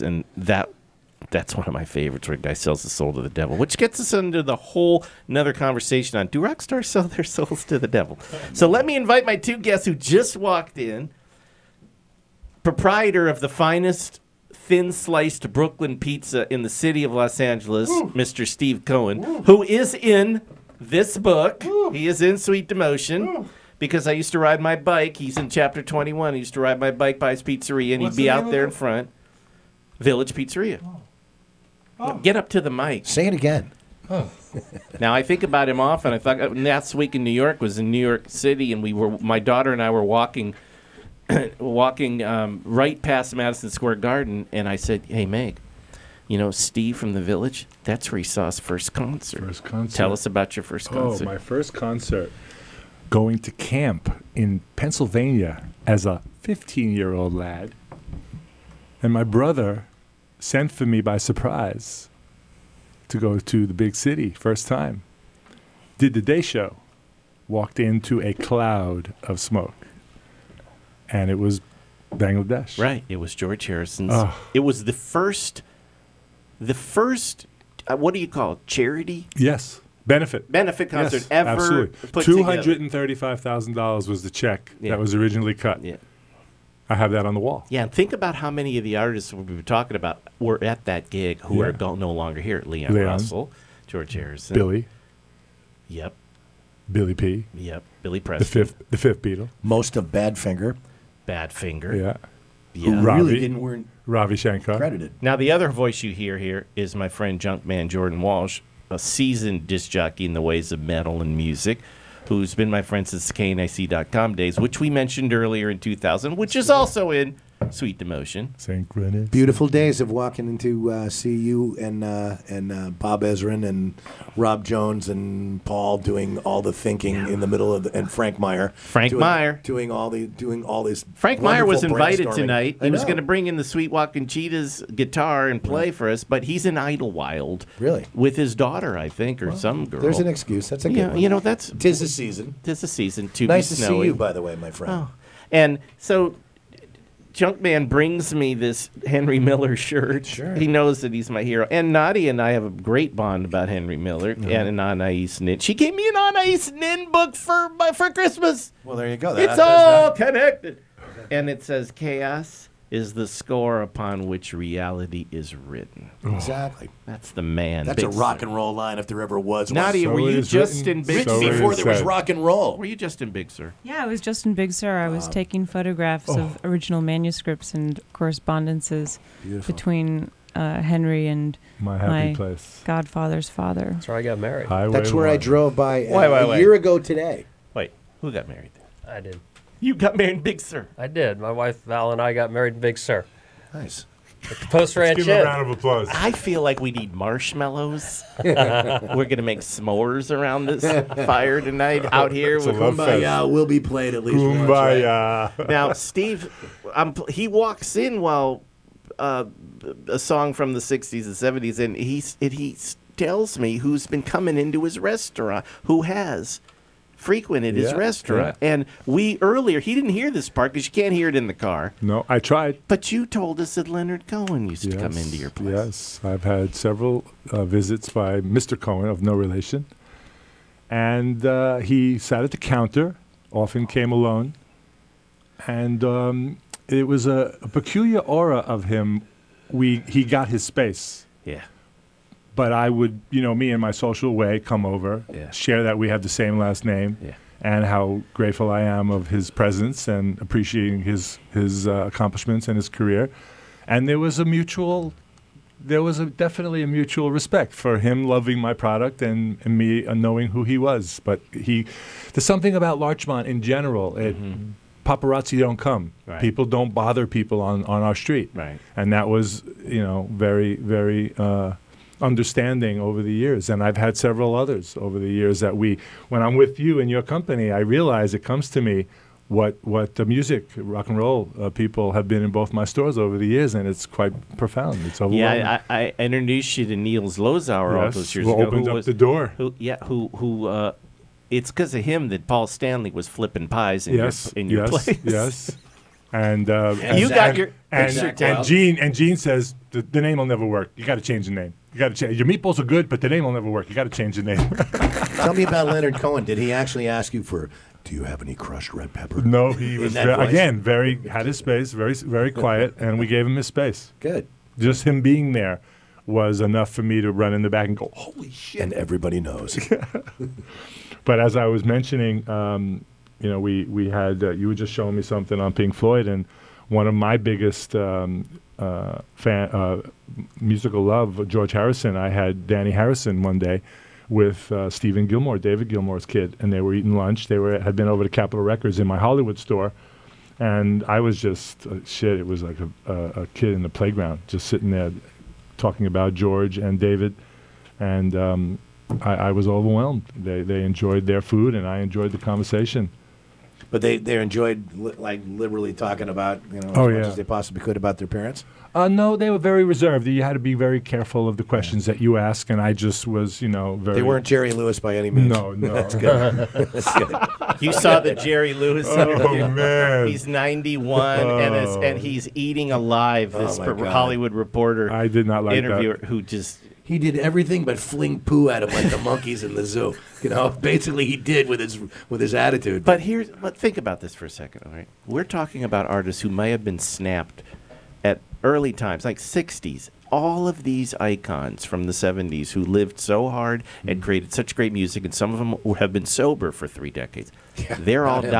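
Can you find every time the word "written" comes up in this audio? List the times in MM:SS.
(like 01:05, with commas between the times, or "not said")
02:45, 02:50.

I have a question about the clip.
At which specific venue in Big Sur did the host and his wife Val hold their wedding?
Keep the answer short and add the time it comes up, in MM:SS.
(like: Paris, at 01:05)
Post Ranch, at 03:14.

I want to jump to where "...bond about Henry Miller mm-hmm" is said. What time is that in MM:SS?
02:33.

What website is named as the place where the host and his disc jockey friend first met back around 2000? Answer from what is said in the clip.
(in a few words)
KNAC.com.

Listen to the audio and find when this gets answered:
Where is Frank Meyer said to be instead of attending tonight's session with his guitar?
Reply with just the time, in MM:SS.
02:16.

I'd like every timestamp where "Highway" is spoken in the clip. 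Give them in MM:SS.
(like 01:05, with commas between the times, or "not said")
03:04.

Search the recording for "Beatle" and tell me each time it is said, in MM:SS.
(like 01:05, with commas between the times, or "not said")
01:39.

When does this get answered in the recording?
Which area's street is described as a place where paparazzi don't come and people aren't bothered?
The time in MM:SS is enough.
04:22.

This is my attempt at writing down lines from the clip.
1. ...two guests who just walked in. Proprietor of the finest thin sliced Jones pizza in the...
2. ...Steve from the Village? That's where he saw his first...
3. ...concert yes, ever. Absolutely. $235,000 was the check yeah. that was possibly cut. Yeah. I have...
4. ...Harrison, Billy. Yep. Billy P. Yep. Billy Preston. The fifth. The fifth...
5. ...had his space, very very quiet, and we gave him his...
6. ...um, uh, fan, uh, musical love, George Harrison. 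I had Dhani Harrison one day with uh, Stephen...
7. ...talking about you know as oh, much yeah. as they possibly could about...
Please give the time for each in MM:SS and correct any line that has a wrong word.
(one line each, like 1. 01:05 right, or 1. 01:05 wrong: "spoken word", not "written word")
1. 00:09 wrong: "Brooklyn", not "Jones"
2. 00:46 right
3. 01:20 wrong: "originally", not "possibly"
4. 01:34 right
5. 05:11 right
6. 05:27 right
7. 05:55 right.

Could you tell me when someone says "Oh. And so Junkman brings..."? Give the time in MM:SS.
02:25.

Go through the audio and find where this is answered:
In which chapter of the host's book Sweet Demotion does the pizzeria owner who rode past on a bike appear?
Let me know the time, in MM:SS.
00:25.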